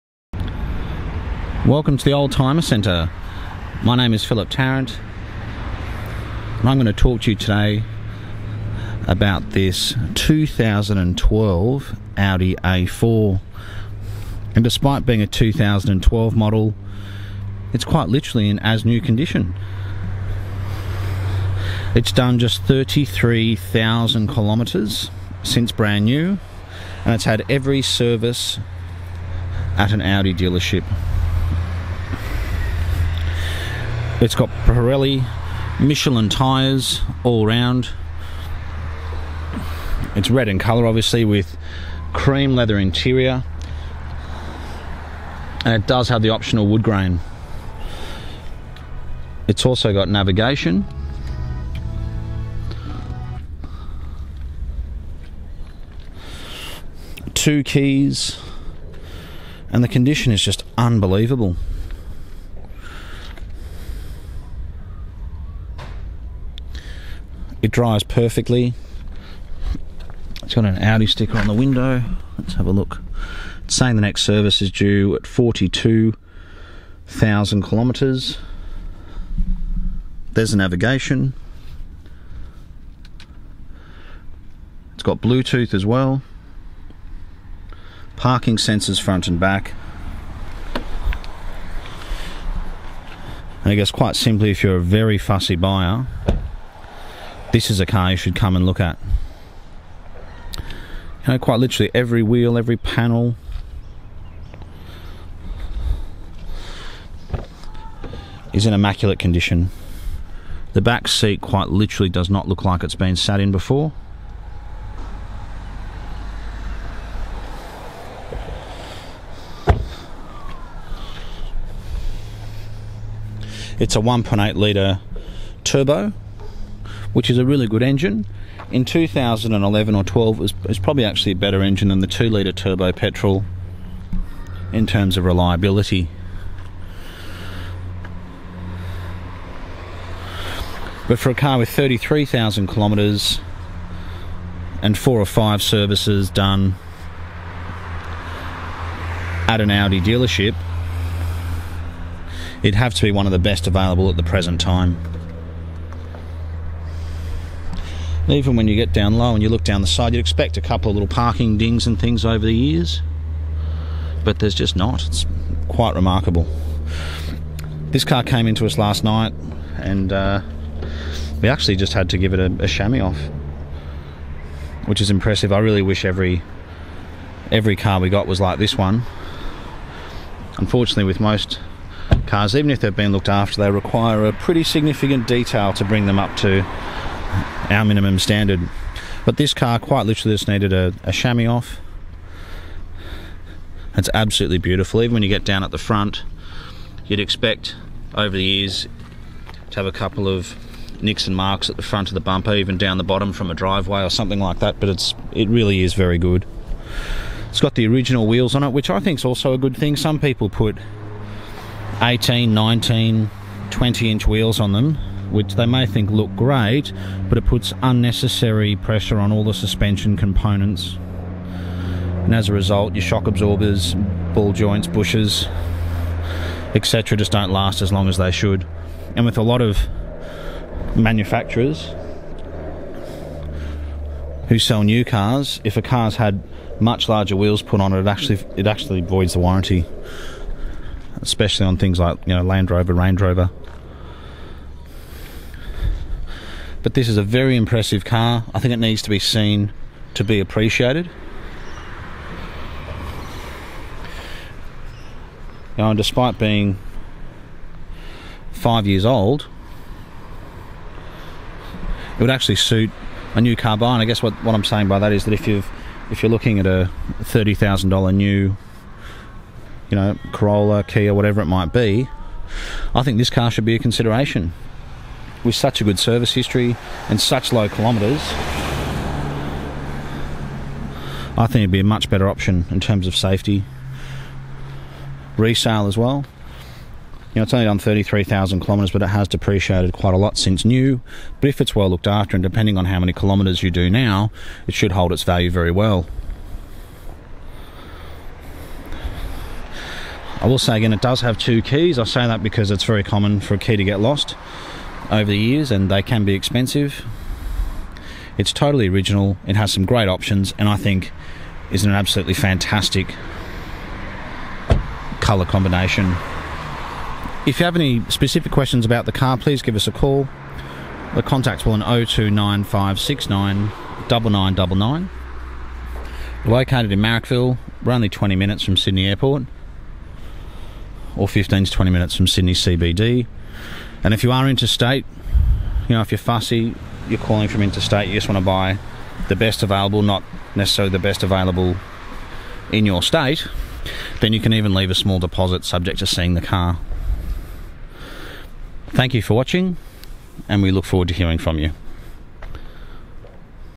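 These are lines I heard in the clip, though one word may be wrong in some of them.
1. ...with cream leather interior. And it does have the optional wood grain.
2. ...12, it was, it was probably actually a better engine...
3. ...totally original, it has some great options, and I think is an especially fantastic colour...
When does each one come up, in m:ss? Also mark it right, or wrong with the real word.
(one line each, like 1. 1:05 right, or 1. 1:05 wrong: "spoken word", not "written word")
1. 0:41 right
2. 2:10 right
3. 5:08 wrong: "absolutely", not "especially".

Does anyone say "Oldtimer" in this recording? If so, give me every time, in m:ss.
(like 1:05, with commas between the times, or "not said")
0:02.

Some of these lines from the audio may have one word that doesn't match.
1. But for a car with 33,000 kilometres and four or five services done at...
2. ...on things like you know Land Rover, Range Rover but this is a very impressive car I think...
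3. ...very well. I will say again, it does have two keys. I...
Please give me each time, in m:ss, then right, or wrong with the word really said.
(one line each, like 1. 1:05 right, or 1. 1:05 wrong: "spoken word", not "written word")
1. 2:21 right
2. 4:01 right
3. 4:55 right.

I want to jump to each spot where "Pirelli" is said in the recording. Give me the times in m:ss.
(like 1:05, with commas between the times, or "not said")
0:34.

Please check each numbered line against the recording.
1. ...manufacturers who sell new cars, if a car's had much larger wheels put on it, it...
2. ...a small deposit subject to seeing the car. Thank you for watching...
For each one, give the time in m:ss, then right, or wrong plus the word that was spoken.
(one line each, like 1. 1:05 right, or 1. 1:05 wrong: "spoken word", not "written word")
1. 3:50 right
2. 5:44 right.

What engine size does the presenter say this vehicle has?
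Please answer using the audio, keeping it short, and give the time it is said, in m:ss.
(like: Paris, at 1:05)
1.8 litre turbo, at 2:03.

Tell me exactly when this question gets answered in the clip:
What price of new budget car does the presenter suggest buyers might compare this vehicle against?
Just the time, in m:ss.
4:27.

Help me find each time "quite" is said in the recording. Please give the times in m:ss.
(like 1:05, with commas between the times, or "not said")
0:17, 1:33, 1:41, 1:51, 2:45, 3:09, 4:49.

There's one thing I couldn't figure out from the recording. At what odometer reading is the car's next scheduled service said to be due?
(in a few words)
42,000 kilometres.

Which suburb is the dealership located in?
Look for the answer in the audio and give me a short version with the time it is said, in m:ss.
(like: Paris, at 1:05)
Marrickville, at 5:26.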